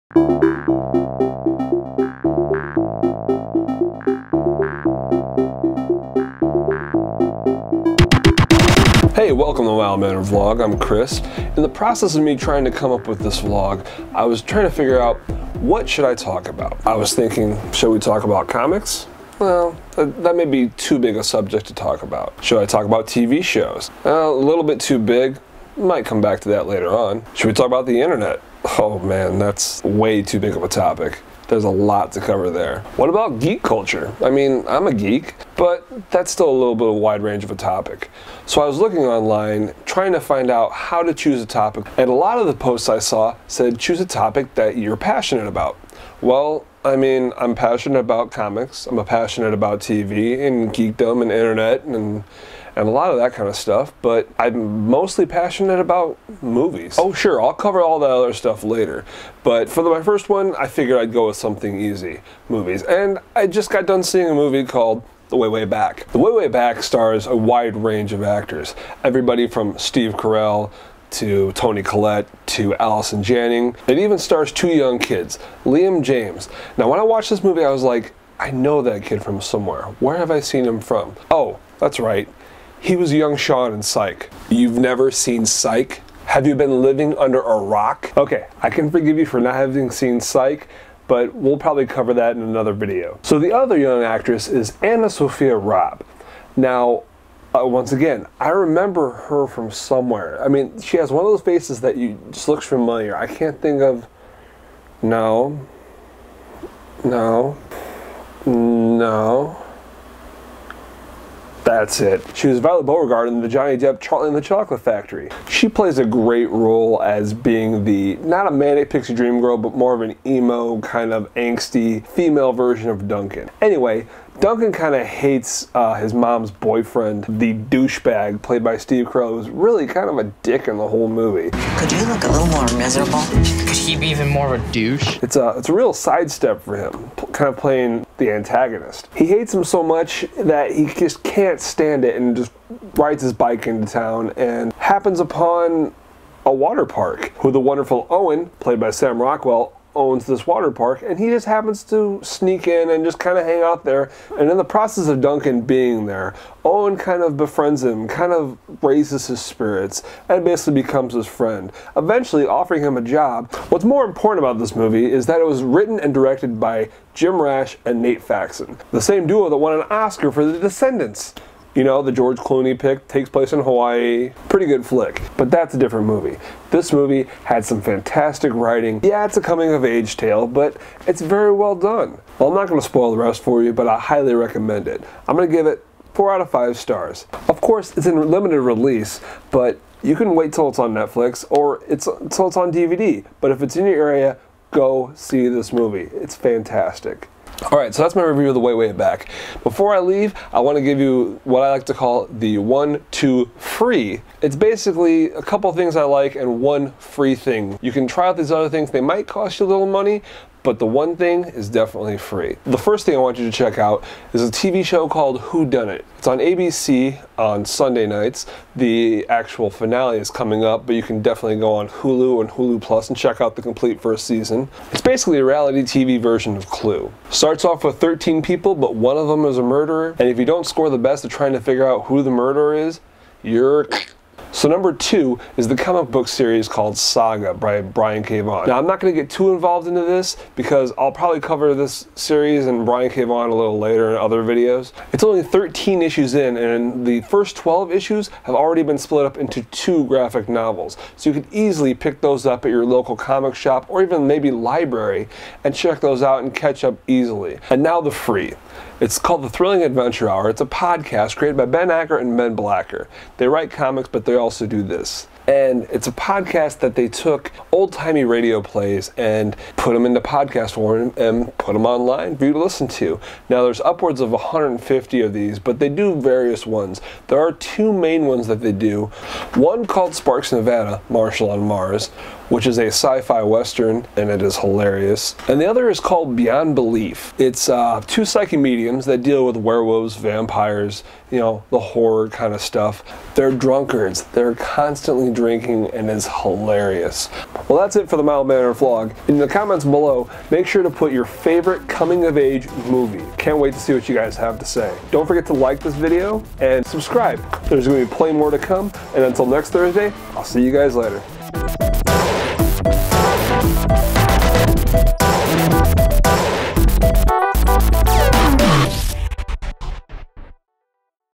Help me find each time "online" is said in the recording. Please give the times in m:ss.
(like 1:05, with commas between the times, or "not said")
0:38, 4:31.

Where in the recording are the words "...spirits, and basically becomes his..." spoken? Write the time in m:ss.
2:39.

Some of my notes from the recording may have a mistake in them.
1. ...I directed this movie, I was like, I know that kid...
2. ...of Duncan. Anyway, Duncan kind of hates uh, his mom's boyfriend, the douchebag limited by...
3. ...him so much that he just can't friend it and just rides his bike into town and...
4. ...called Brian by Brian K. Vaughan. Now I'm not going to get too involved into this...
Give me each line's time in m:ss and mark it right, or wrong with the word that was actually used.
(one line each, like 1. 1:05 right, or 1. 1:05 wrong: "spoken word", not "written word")
1. 1:16 wrong: "watched", not "directed"
2. 2:02 wrong: "played", not "limited"
3. 2:19 wrong: "stand", not "friend"
4. 3:56 wrong: "Saga", not "Brian".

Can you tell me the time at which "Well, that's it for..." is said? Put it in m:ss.
4:57.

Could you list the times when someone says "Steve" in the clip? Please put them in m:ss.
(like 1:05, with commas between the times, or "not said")
1:09, 2:08.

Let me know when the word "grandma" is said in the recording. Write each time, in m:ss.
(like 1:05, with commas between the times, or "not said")
not said.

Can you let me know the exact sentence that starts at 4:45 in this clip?
And the other is called Beyond Belief.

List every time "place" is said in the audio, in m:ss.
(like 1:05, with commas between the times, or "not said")
2:53.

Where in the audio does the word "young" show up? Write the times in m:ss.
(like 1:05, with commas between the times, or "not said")
1:14, 1:23, 1:33.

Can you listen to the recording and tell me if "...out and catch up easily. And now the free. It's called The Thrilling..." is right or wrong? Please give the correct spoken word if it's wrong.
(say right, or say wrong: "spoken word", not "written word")
right.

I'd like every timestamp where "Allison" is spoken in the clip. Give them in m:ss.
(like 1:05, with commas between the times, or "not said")
1:12.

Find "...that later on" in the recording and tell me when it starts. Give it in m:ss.
0:26.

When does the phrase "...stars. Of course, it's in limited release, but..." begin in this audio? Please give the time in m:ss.
3:06.